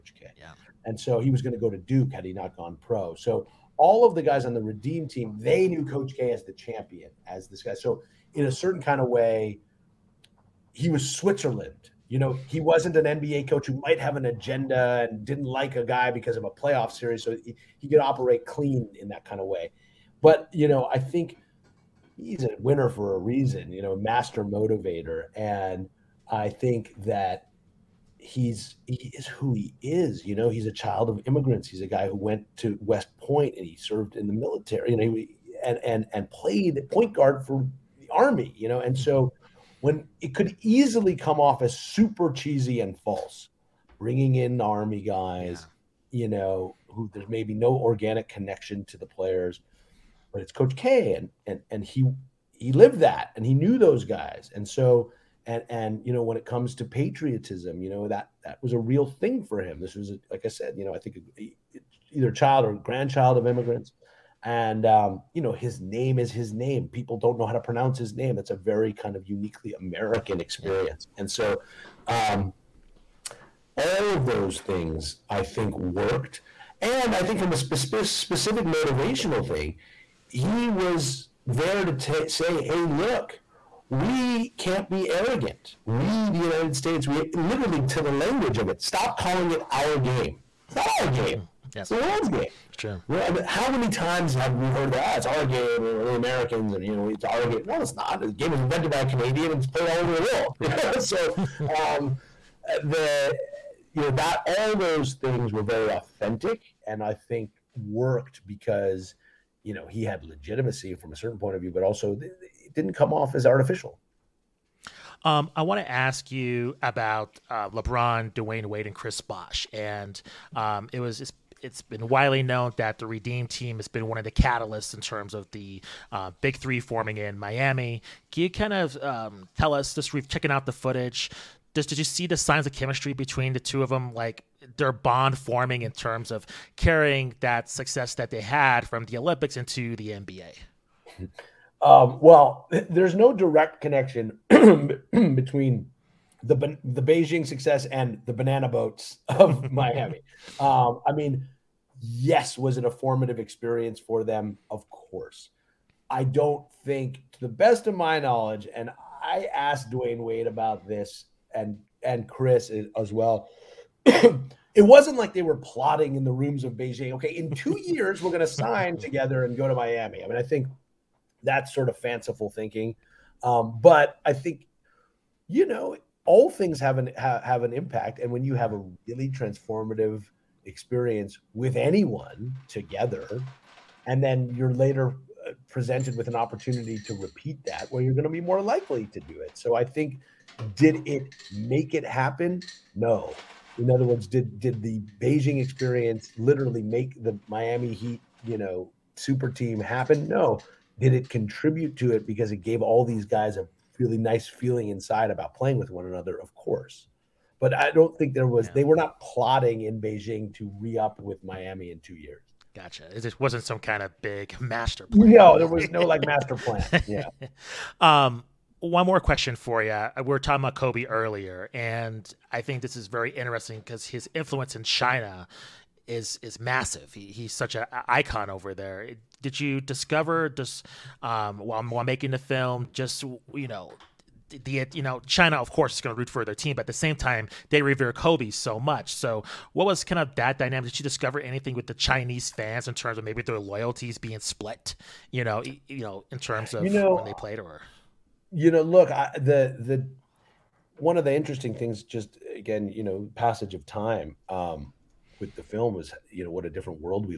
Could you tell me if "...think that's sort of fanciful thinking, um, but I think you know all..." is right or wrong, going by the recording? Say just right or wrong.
right.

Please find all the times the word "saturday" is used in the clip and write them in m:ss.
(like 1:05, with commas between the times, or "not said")
not said.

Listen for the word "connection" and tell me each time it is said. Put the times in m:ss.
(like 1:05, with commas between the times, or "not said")
0:48, 2:23.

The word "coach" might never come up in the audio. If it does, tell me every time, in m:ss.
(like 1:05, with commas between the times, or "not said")
0:05, 0:13, 0:50.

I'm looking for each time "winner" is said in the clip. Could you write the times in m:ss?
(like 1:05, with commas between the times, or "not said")
0:22.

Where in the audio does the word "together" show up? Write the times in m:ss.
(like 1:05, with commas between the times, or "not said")
2:48, 3:02.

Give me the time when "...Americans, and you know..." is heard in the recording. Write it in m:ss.
1:36.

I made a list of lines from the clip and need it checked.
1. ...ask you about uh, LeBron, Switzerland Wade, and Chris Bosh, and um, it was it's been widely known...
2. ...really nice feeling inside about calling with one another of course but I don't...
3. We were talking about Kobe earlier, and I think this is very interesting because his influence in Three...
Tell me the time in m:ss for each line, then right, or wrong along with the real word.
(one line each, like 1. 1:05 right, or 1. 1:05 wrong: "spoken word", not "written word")
1. 1:55 wrong: "Dwyane", not "Switzerland"
2. 3:23 wrong: "playing", not "calling"
3. 3:40 wrong: "China", not "Three".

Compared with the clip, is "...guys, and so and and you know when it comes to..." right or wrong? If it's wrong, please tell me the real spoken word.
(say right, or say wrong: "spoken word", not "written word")
right.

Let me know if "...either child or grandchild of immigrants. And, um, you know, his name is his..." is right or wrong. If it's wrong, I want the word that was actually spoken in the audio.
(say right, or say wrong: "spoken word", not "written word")
right.